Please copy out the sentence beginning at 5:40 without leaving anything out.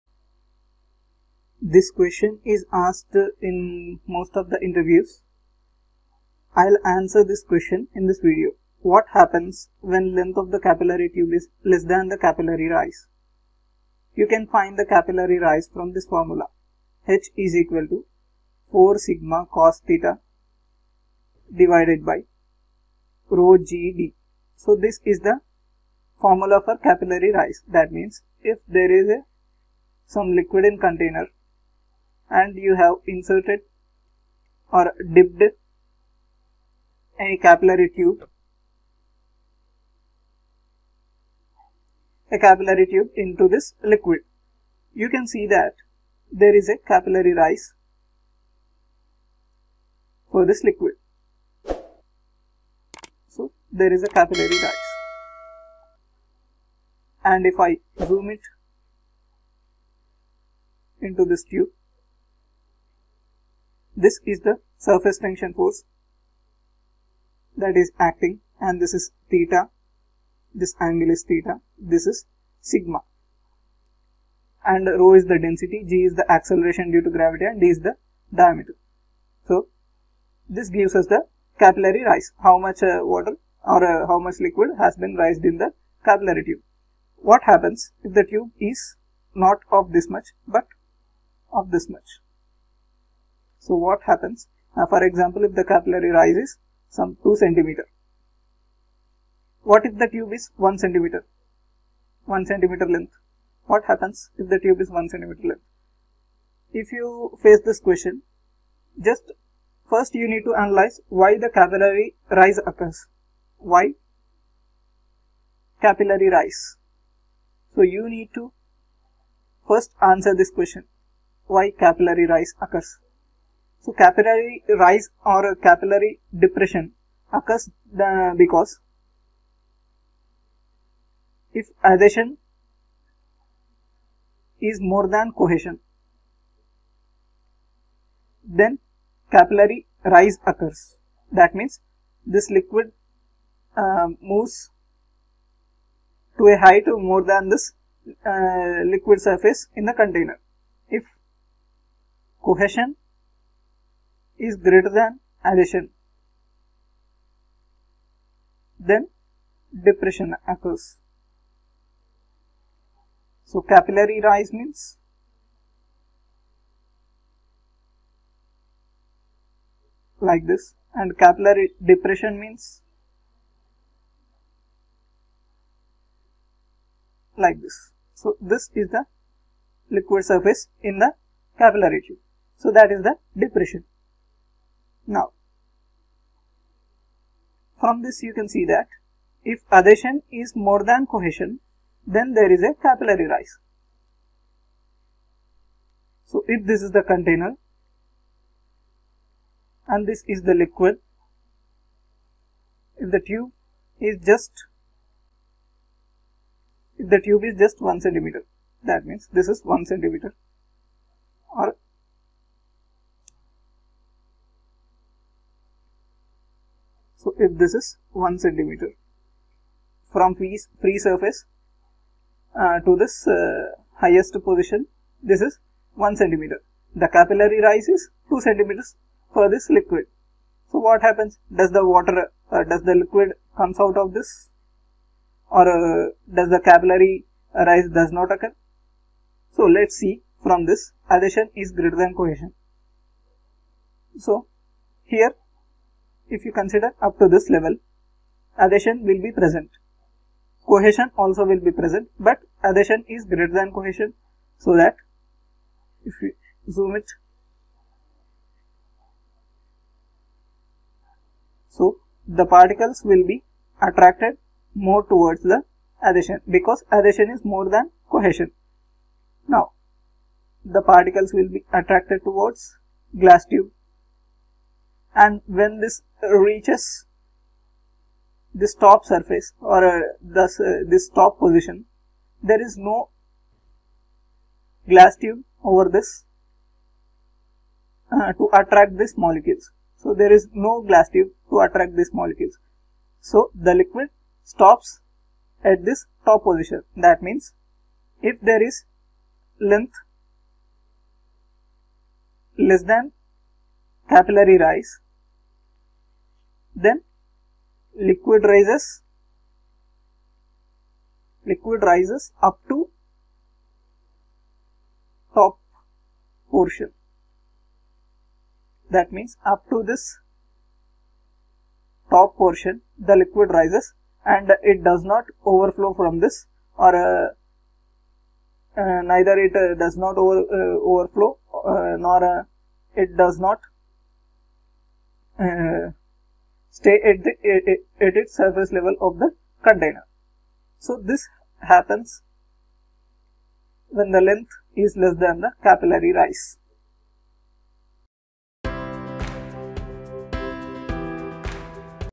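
So this happens when the length is less than the capillary rise.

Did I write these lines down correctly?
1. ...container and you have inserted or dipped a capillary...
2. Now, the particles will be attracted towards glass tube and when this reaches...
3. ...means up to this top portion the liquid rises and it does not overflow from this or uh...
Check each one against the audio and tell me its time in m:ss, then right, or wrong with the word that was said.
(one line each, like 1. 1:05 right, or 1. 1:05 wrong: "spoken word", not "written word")
1. 0:30 right
2. 4:29 right
3. 5:19 right.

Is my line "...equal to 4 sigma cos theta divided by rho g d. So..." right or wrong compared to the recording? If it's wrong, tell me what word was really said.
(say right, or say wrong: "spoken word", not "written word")
right.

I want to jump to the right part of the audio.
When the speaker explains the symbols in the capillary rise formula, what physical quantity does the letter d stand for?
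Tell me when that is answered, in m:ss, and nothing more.
1:18.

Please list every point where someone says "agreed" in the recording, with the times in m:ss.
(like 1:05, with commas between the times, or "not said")
not said.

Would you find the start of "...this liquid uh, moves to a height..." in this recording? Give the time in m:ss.
2:22.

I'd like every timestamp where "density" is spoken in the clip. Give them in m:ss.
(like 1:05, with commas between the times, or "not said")
1:15.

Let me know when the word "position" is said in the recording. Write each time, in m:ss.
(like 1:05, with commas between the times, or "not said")
3:44, 4:41, 4:56.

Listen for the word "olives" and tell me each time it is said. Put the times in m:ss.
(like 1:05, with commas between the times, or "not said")
not said.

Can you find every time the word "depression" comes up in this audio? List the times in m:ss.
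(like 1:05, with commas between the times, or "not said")
2:06, 2:39, 2:51, 3:03.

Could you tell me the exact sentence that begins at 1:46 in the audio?
If you face this question, just first you need to analyze why the capillary rise occurs.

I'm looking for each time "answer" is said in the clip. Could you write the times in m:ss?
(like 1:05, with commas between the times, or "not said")
0:06, 2:00.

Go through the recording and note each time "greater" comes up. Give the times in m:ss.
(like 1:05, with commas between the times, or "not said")
2:34, 4:01, 4:13.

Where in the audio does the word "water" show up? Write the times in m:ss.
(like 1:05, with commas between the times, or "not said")
1:23, 3:51.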